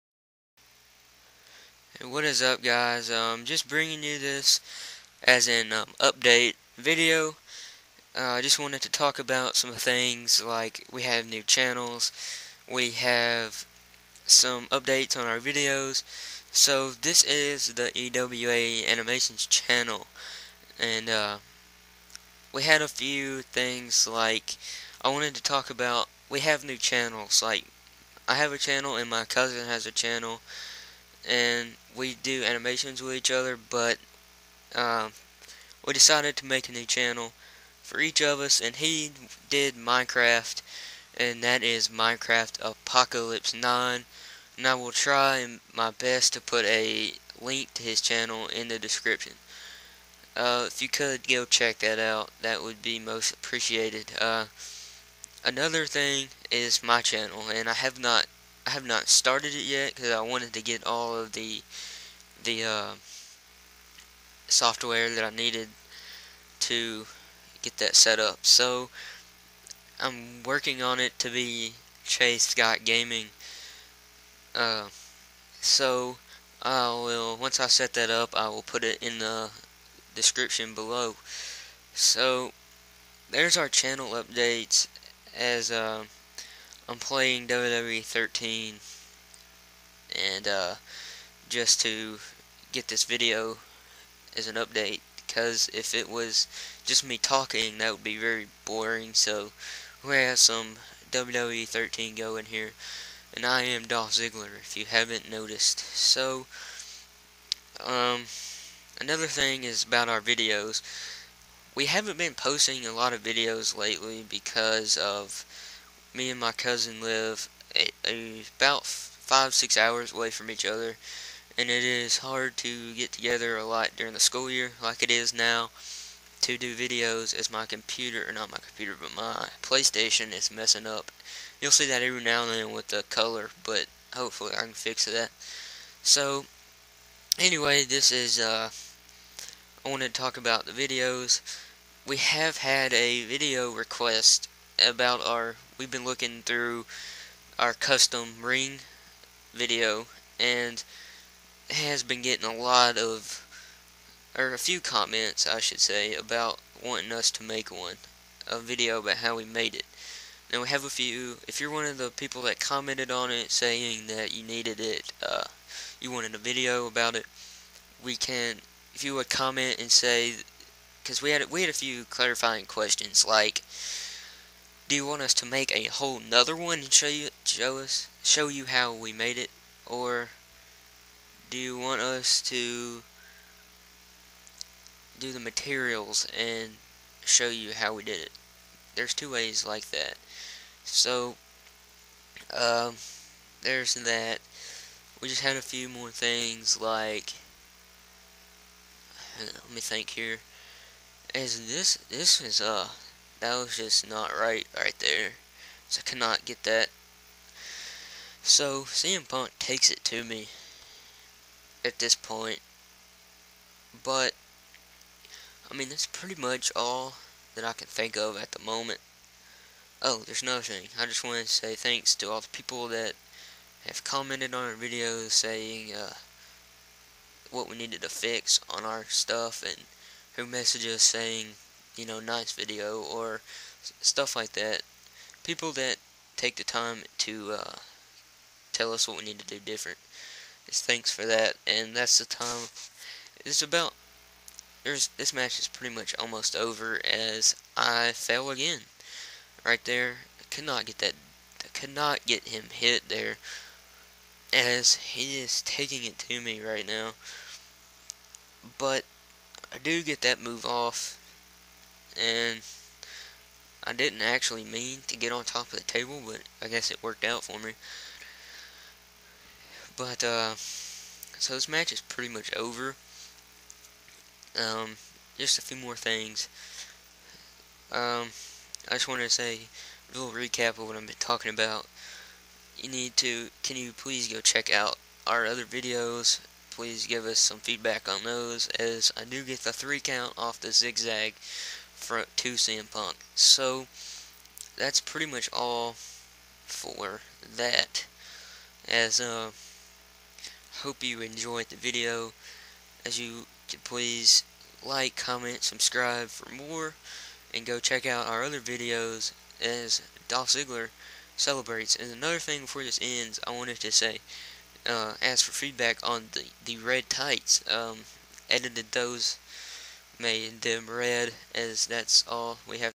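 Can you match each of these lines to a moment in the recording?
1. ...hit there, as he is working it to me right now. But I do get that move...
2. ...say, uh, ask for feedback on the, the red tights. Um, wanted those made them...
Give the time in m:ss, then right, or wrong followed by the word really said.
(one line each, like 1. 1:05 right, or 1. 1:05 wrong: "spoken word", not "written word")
1. 4:12 wrong: "taking", not "working"
2. 5:13 wrong: "edited", not "wanted".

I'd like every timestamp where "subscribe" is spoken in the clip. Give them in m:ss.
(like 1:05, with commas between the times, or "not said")
5:05.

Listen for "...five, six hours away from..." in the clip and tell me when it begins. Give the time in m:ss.
1:58.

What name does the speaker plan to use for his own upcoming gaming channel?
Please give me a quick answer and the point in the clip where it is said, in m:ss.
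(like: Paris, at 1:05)
Chase Scott Gaming, at 1:12.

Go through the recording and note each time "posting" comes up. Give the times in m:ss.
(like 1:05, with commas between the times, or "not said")
1:52.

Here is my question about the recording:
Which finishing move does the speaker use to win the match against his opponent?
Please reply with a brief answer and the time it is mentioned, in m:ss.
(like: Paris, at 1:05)
zigzag, at 4:50.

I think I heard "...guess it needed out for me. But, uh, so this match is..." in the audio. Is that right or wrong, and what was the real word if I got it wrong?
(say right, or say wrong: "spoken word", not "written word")
wrong: "worked", not "needed".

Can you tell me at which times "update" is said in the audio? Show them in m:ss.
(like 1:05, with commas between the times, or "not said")
0:05, 0:14, 1:24, 1:34.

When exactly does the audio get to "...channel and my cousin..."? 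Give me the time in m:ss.
0:28.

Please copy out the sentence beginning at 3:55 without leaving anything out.
People that take the time to uh, tell us what we need to do different.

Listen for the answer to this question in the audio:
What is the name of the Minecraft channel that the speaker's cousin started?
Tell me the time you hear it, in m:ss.
0:41.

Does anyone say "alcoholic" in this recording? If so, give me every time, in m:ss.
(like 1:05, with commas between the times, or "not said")
not said.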